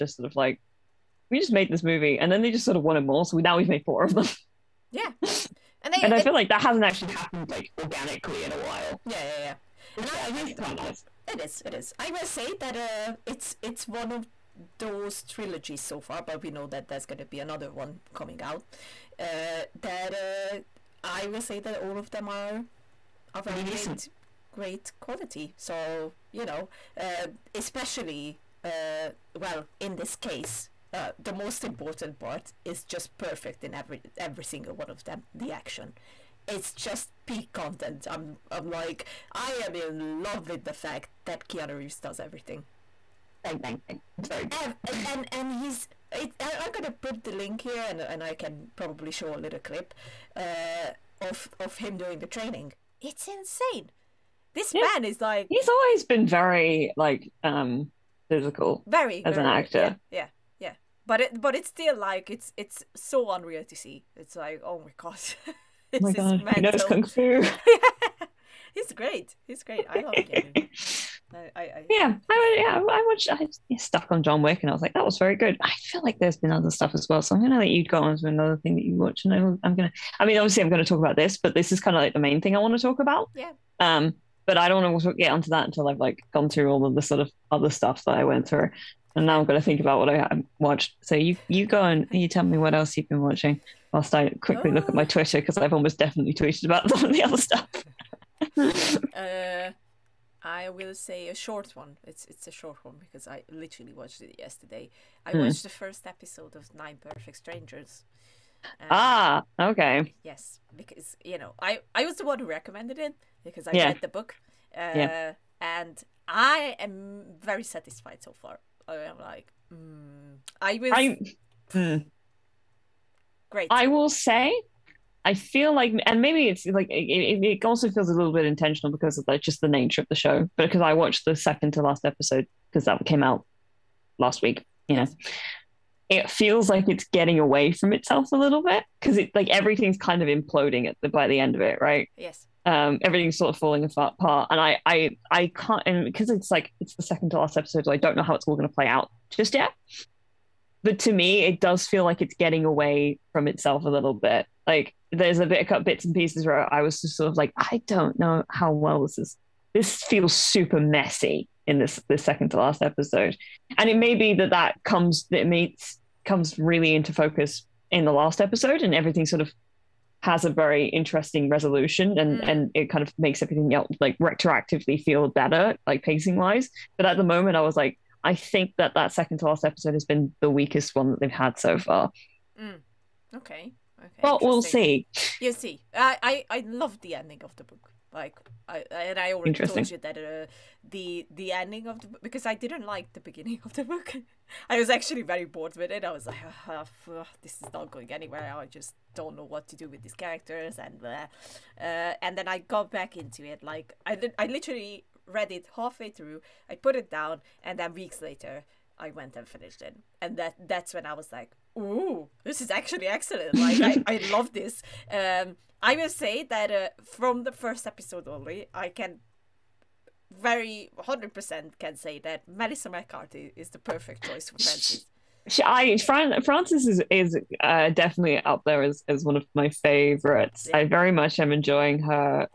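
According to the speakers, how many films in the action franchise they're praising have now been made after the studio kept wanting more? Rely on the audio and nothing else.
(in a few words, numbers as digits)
4.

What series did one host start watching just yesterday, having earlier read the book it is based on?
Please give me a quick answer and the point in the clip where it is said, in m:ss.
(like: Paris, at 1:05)
Nine Perfect Strangers, at 1:46.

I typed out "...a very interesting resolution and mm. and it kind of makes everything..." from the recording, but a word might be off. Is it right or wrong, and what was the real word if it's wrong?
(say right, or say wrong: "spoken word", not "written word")
right.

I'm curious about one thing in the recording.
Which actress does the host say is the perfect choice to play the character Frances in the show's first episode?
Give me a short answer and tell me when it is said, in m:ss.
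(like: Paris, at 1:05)
Melissa McCarthy, at 3:42.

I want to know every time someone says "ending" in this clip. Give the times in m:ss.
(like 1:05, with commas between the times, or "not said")
3:07, 3:11.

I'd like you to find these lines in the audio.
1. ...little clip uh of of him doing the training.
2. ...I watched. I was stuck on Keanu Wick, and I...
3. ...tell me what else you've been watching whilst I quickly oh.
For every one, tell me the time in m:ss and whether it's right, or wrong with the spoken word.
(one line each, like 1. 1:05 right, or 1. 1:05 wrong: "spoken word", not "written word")
1. 0:49 right
2. 1:12 wrong: "John", not "Keanu"
3. 1:32 right.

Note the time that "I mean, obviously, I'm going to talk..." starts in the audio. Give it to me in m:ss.
1:20.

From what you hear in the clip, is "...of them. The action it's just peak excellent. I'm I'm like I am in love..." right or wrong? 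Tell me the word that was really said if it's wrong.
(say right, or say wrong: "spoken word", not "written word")
wrong: "content", not "excellent".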